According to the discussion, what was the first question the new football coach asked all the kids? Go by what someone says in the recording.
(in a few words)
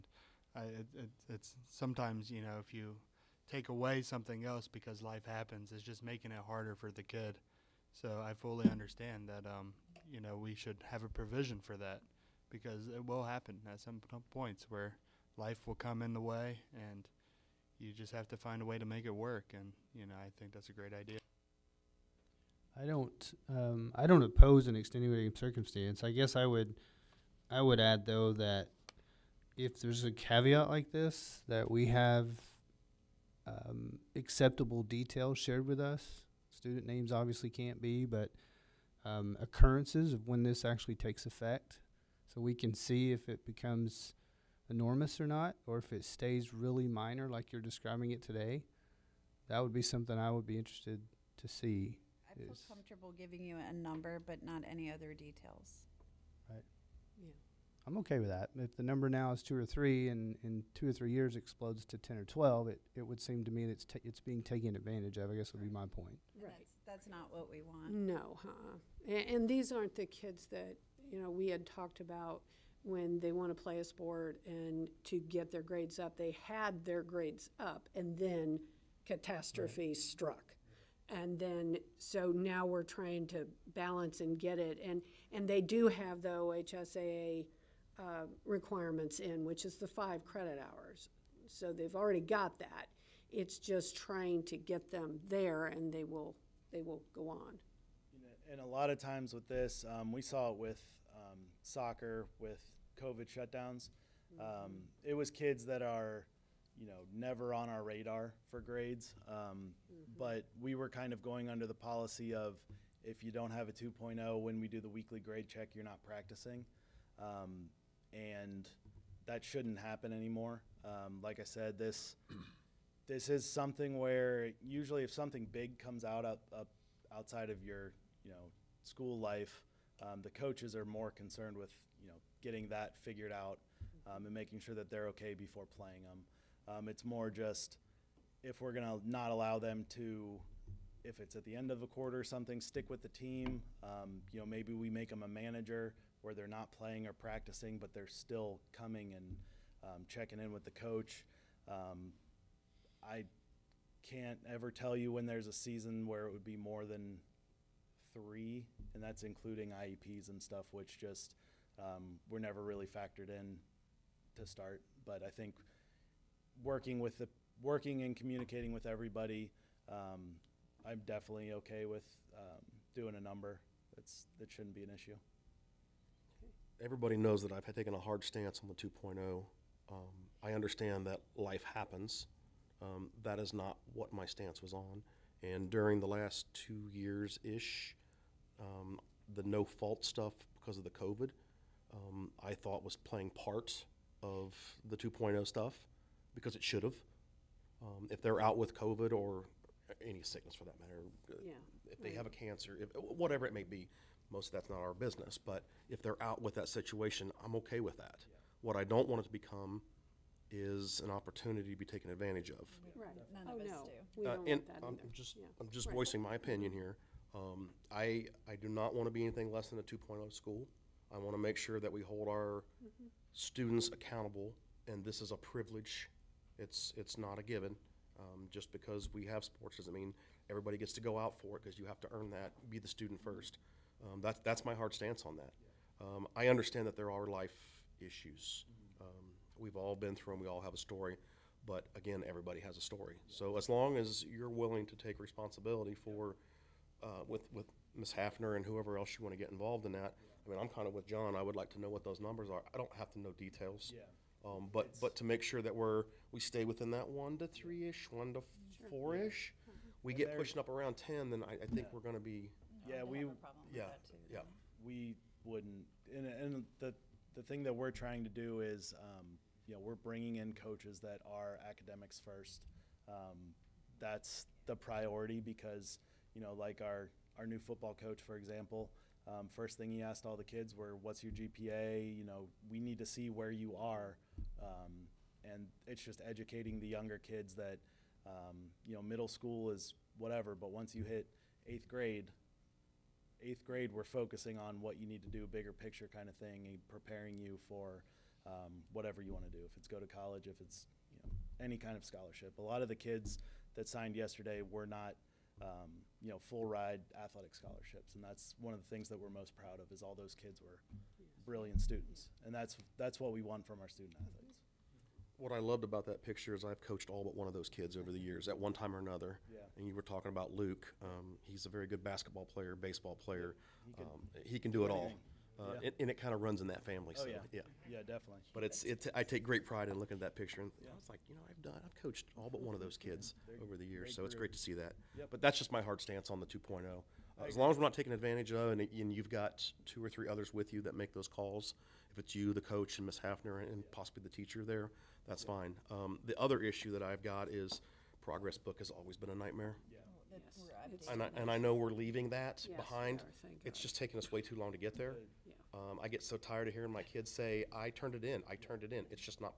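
What's your GPA?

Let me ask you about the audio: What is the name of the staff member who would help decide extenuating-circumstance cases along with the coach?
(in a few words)
Ms. Hafner.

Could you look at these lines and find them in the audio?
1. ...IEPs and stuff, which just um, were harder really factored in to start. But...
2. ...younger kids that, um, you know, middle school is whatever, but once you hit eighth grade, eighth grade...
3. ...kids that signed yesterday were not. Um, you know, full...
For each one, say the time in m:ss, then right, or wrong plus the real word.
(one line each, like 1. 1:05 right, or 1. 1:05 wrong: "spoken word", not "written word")
1. 2:39 wrong: "never", not "harder"
2. 4:46 right
3. 5:02 right.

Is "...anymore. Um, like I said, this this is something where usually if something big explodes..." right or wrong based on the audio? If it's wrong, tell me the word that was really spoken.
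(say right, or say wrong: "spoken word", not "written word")
wrong: "comes", not "explodes".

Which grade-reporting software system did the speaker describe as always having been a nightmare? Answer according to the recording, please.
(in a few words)
ProgressBook.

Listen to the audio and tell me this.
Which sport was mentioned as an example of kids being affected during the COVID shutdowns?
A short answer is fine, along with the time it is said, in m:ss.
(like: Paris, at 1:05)
soccer, at 1:41.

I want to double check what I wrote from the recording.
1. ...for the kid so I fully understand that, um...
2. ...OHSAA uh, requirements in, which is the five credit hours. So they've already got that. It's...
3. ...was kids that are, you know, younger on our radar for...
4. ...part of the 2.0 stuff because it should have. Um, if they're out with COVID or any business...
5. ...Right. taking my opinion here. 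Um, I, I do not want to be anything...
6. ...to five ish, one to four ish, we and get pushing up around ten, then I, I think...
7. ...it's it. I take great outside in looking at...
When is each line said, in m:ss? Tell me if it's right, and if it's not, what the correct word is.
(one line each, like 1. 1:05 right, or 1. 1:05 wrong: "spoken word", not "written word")
1. 0:06 right
2. 1:26 right
3. 1:45 wrong: "never", not "younger"
4. 3:13 wrong: "sickness", not "business"
5. 3:35 wrong: "voicing", not "taking"
6. 4:17 wrong: "three", not "five"
7. 5:28 wrong: "pride", not "outside".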